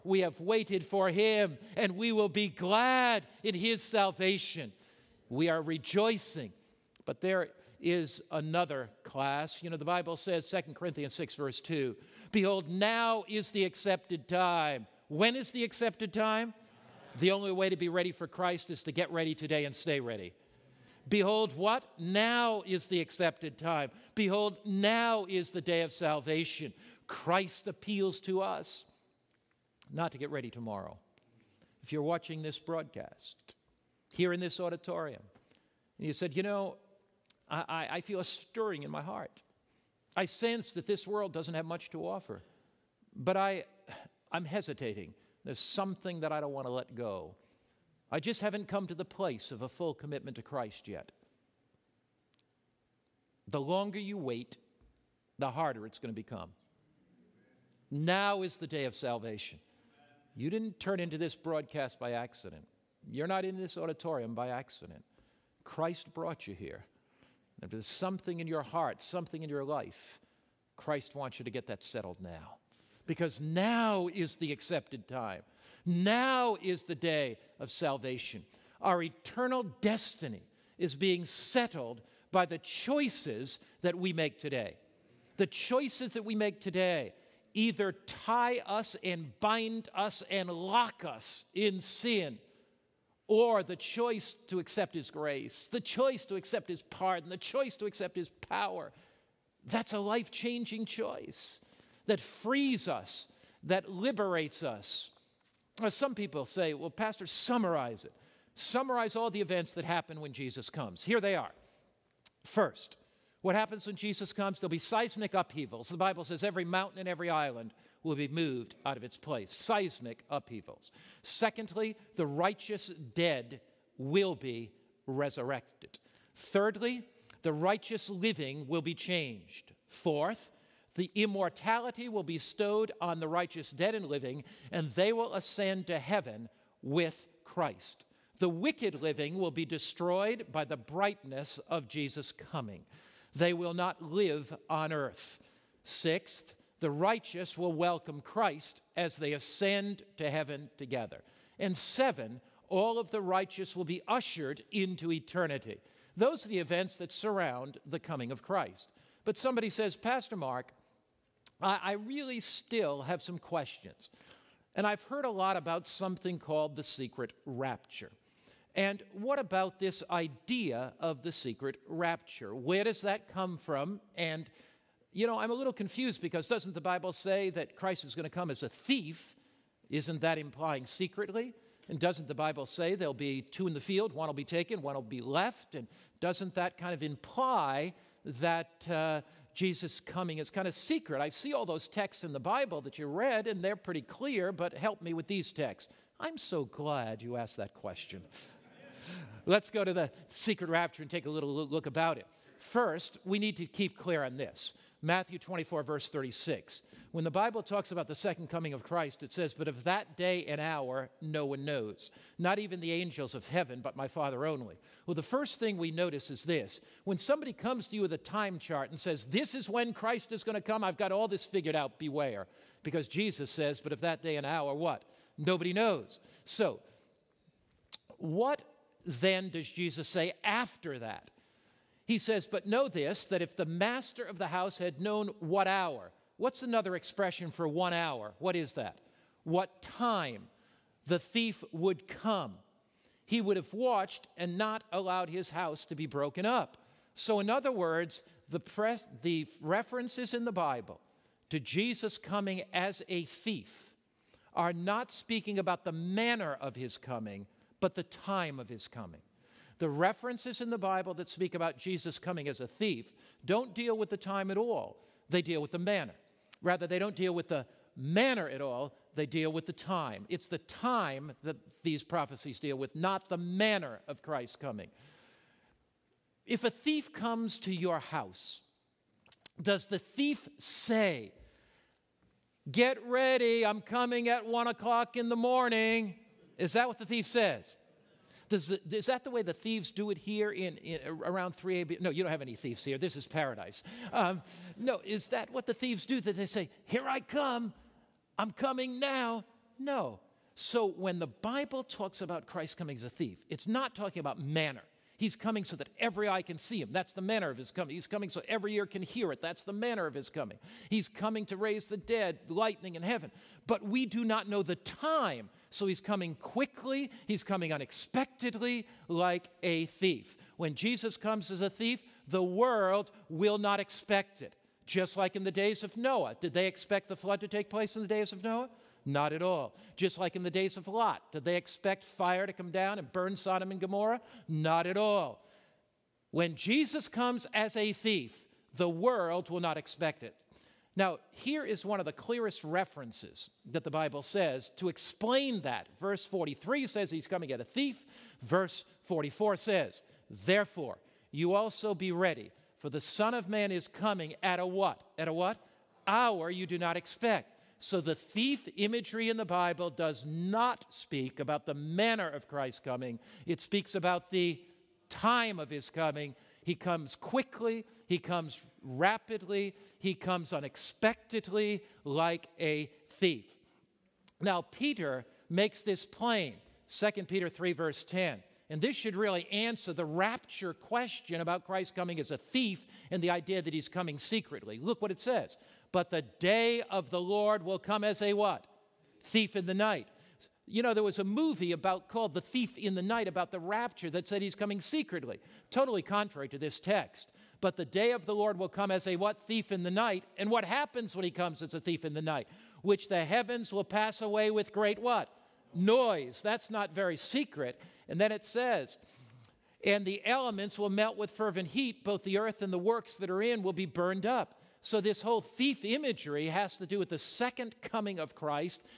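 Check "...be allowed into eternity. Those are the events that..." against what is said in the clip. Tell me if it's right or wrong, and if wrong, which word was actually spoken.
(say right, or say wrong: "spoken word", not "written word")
wrong: "ushered", not "allowed".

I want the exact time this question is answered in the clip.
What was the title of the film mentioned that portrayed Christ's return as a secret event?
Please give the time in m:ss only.
6:32.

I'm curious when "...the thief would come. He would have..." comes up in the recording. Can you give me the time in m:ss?
4:01.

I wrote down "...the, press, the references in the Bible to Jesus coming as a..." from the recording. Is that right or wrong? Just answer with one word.
right.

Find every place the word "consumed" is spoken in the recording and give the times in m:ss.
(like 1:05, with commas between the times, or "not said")
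not said.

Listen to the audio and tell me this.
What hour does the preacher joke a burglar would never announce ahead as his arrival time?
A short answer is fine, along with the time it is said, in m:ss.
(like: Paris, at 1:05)
1 o'clock in the morning, at 4:44.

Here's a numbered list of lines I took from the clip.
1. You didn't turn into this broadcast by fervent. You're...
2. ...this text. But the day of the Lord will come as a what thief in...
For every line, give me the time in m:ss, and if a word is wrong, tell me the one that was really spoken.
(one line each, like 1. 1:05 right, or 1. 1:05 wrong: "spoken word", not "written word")
1. 1:00 wrong: "accident", not "fervent"
2. 6:36 right.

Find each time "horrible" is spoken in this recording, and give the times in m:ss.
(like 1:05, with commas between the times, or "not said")
not said.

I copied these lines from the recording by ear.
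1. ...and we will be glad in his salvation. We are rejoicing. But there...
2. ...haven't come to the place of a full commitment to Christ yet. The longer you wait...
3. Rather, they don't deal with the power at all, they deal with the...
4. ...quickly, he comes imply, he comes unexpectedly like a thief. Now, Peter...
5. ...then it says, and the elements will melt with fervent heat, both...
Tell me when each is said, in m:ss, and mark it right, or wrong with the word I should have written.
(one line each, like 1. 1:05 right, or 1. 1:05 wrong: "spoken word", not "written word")
1. 0:01 right
2. 0:48 right
3. 4:26 wrong: "manner", not "power"
4. 6:07 wrong: "rapidly", not "imply"
5. 6:48 right.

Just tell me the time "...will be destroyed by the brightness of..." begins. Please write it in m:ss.
2:19.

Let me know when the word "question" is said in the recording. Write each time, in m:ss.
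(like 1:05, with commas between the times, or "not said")
2:43, 3:17, 6:20.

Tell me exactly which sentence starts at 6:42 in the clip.
Which the heavens will pass away with great what?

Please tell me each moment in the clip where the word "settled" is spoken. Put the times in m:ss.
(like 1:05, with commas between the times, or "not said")
1:11, 1:21.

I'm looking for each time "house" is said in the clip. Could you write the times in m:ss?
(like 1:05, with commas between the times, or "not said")
3:54, 4:05, 4:37.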